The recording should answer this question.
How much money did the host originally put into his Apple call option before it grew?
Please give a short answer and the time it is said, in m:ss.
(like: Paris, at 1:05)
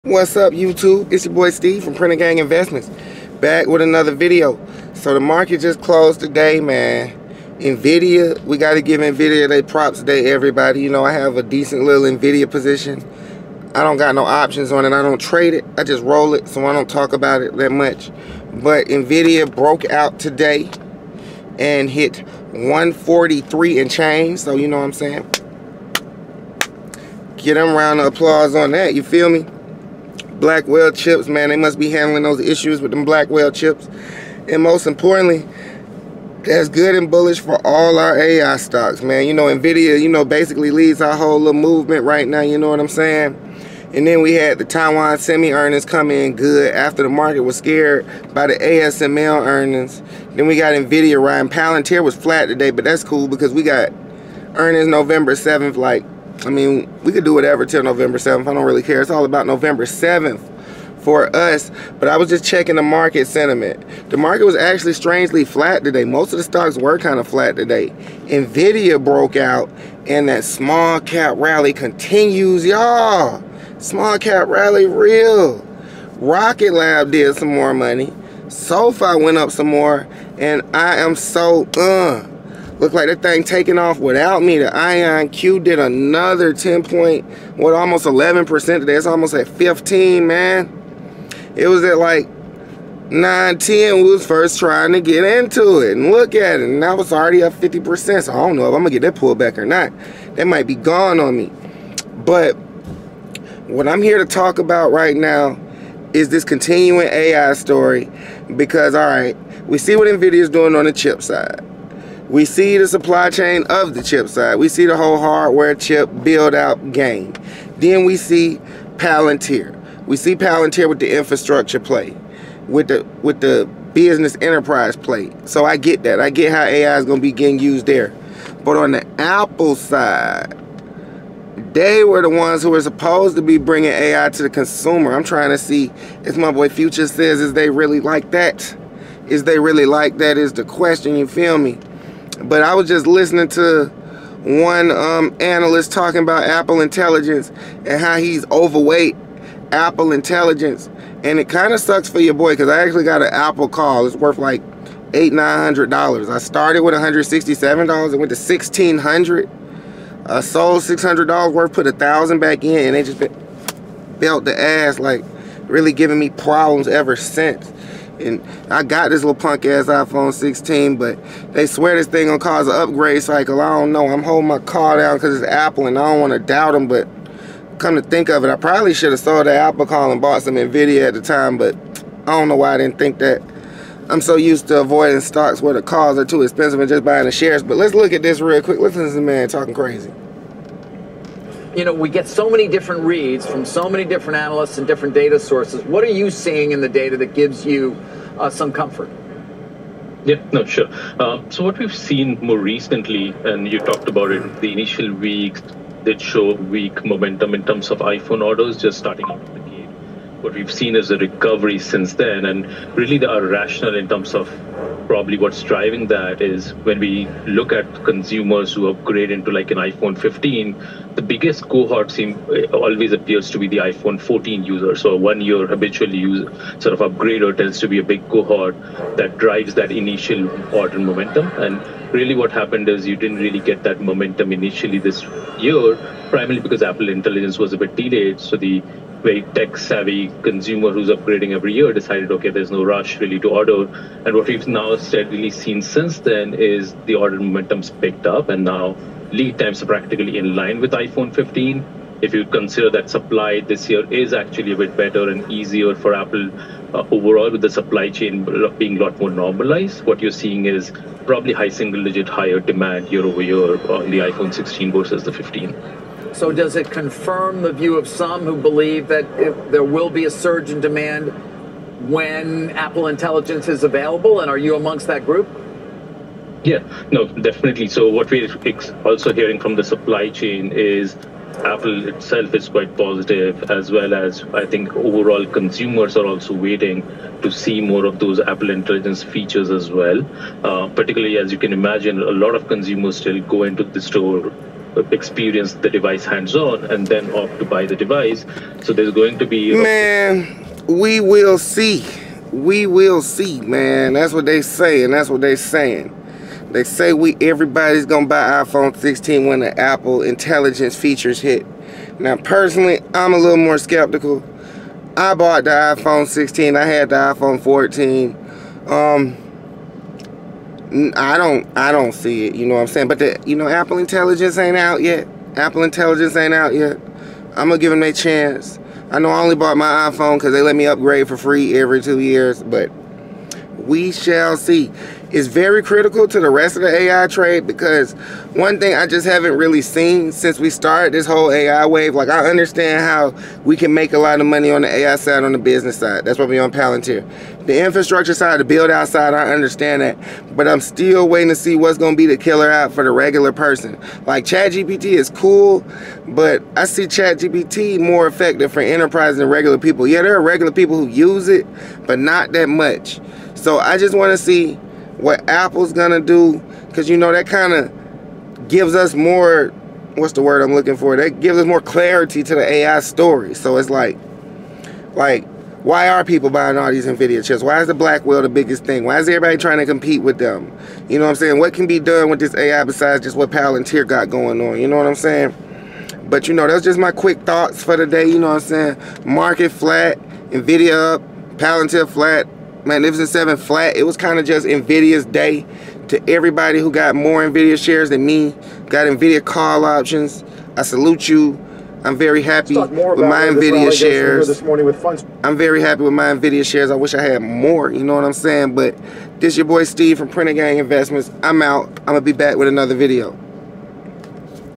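$167, at 2:36.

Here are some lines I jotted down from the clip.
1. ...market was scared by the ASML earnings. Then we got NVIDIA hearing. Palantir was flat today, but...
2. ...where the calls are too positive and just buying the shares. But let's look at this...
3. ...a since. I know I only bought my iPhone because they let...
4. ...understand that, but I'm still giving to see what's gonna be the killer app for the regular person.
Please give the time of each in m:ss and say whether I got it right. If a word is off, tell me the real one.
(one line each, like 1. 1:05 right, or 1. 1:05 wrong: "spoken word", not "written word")
1. 0:47 wrong: "riding", not "hearing"
2. 3:05 wrong: "expensive", not "positive"
3. 5:28 wrong: "chance", not "since"
4. 5:49 wrong: "waiting", not "giving".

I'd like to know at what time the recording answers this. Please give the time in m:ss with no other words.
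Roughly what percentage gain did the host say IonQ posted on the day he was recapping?
1:27.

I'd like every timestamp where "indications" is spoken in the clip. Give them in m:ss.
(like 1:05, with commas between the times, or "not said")
not said.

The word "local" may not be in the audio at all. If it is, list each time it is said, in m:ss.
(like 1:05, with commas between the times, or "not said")
not said.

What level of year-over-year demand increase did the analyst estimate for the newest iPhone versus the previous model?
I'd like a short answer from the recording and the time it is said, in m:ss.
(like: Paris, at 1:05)
high single digit, at 4:21.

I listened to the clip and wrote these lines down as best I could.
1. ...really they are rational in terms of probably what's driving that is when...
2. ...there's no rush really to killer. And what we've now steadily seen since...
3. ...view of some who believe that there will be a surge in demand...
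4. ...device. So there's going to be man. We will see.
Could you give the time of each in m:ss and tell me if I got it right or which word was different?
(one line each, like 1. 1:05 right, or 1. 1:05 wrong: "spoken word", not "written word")
1. 3:32 right
2. 4:02 wrong: "order", not "killer"
3. 4:27 right
4. 4:57 right.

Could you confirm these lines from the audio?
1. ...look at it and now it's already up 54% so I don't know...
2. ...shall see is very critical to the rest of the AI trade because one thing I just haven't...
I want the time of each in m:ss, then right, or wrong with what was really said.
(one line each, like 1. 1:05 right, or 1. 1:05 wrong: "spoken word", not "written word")
1. 1:36 wrong: "50", not "54"
2. 5:34 right.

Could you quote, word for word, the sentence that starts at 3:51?
And really what happened is you didn't really get that momentum initially this year, primarily because Apple Intelligence was a bit delayed.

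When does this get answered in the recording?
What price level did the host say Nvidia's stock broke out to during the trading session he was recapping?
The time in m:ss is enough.
0:22.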